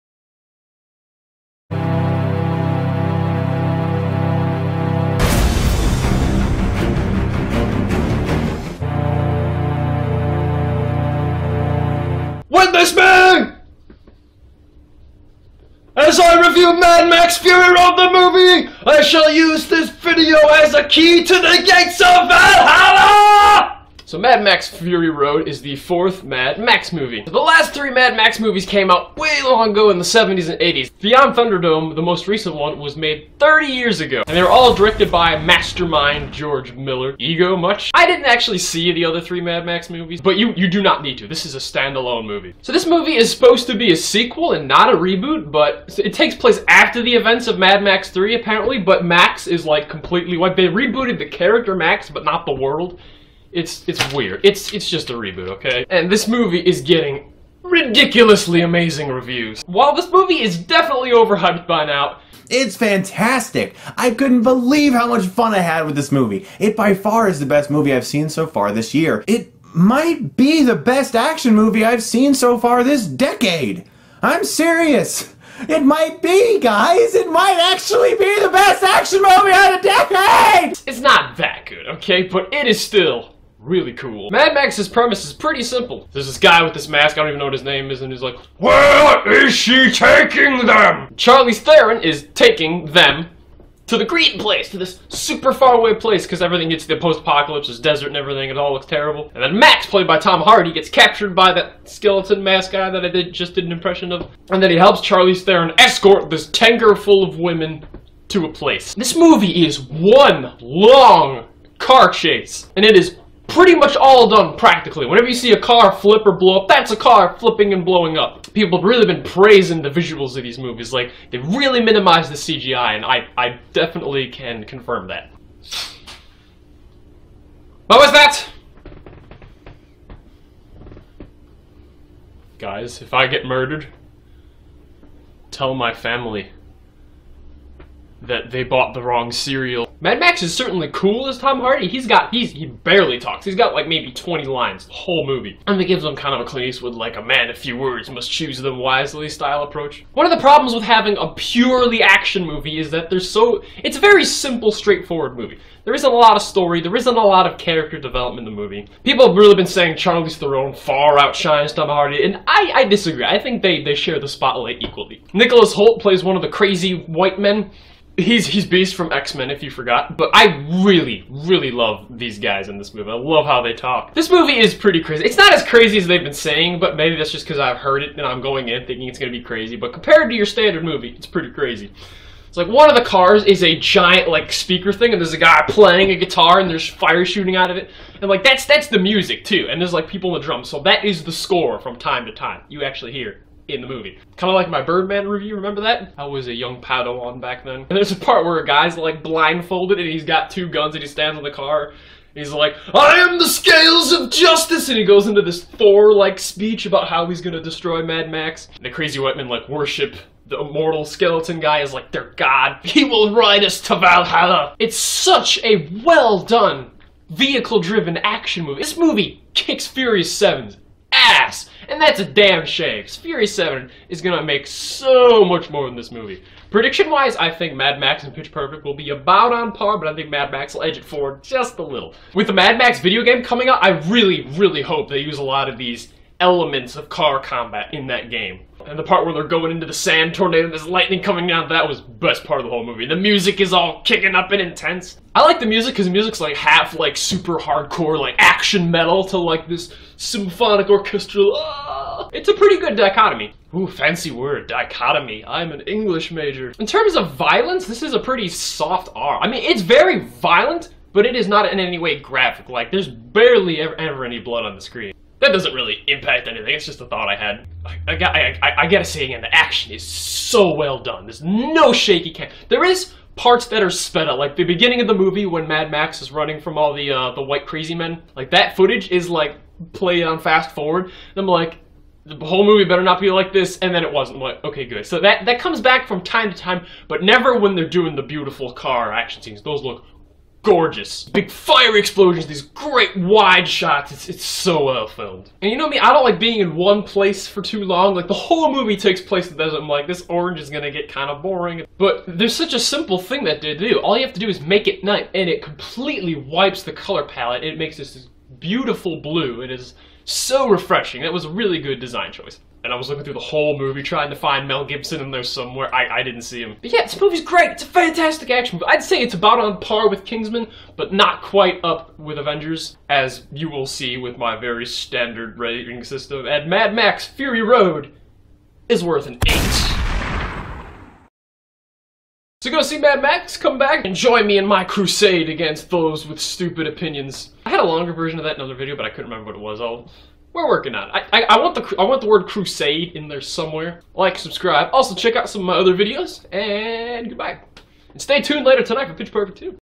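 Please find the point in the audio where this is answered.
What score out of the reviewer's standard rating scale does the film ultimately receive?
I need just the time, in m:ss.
5:29.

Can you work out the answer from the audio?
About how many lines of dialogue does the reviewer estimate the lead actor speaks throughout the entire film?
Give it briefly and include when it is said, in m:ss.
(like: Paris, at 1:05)
20, at 2:24.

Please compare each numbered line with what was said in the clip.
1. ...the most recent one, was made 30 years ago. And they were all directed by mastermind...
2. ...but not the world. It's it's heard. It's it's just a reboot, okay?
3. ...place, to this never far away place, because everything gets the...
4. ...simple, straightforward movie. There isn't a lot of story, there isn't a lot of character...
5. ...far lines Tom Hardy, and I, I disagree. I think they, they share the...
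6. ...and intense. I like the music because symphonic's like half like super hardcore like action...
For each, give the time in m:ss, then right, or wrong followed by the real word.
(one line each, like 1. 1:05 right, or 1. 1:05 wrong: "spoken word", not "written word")
1. 0:31 right
2. 0:52 wrong: "weird", not "heard"
3. 1:34 wrong: "super", not "never"
4. 2:34 right
5. 2:40 wrong: "outshines", not "lines"
6. 4:04 wrong: "music", not "symphonic".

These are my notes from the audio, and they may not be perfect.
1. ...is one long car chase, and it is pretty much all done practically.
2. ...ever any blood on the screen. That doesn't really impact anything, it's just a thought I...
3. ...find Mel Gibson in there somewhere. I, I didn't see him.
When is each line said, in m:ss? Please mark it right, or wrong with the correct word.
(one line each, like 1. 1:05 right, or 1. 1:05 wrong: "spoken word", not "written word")
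1. 1:49 right
2. 4:23 right
3. 5:14 right.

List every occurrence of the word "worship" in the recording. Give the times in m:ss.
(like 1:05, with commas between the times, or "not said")
3:29.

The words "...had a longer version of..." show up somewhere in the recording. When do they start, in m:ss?
5:37.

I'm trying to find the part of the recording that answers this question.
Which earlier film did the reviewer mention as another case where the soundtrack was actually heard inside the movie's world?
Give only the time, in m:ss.
3:14.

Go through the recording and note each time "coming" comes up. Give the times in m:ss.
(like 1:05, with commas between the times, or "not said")
3:53, 4:01.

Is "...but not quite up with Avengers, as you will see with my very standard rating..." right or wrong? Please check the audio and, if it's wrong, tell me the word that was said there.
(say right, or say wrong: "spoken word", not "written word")
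right.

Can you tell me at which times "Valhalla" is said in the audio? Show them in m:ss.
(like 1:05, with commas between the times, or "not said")
0:22, 3:33.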